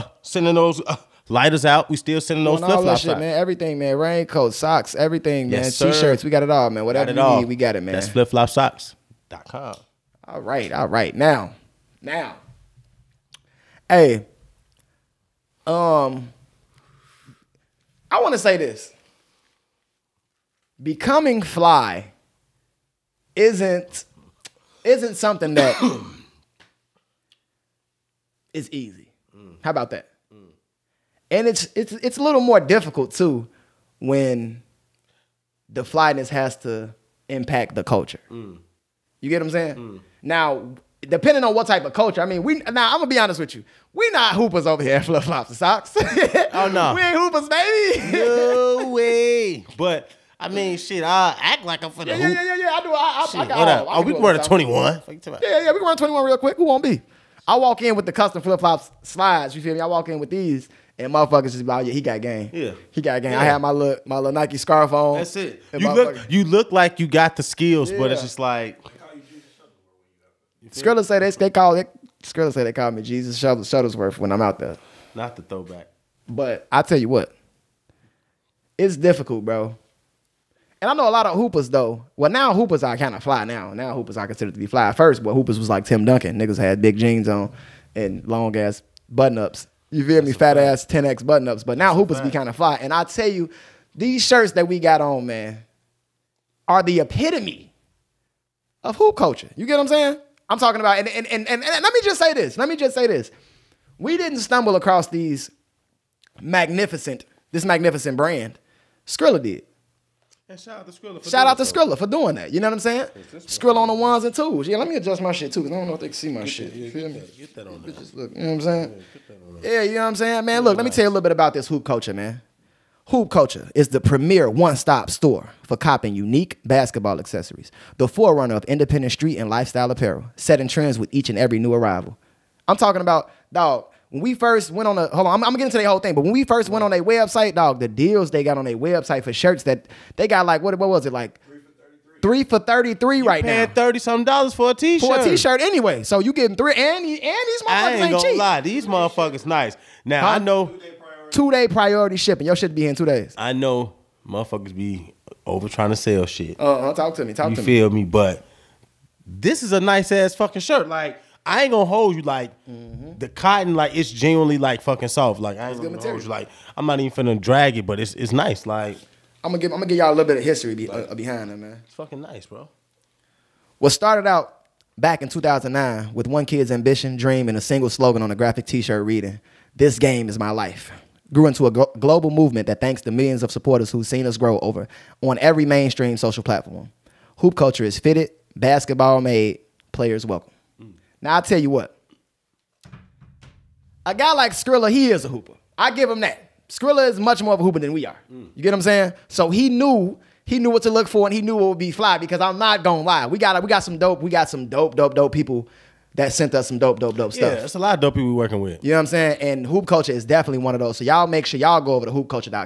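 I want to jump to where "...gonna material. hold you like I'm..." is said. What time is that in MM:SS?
02:45.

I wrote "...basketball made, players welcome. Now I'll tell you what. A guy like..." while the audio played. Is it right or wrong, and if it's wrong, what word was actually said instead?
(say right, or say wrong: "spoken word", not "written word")
right.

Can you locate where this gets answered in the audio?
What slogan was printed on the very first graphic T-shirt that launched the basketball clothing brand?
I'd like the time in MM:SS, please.
02:59.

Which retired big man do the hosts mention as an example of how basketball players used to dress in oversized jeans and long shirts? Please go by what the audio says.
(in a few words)
Tim Duncan.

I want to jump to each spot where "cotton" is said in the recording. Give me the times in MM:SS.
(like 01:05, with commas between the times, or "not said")
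02:43.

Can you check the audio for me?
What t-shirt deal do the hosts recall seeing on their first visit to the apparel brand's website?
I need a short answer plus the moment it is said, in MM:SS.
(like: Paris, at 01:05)
3 for 33, at 02:22.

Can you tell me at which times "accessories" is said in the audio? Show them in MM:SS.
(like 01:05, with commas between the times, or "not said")
02:07.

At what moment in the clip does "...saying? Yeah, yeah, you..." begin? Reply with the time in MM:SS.
01:58.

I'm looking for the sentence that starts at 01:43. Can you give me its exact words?
We didn't stumble across these magnificent, this magnificent brand.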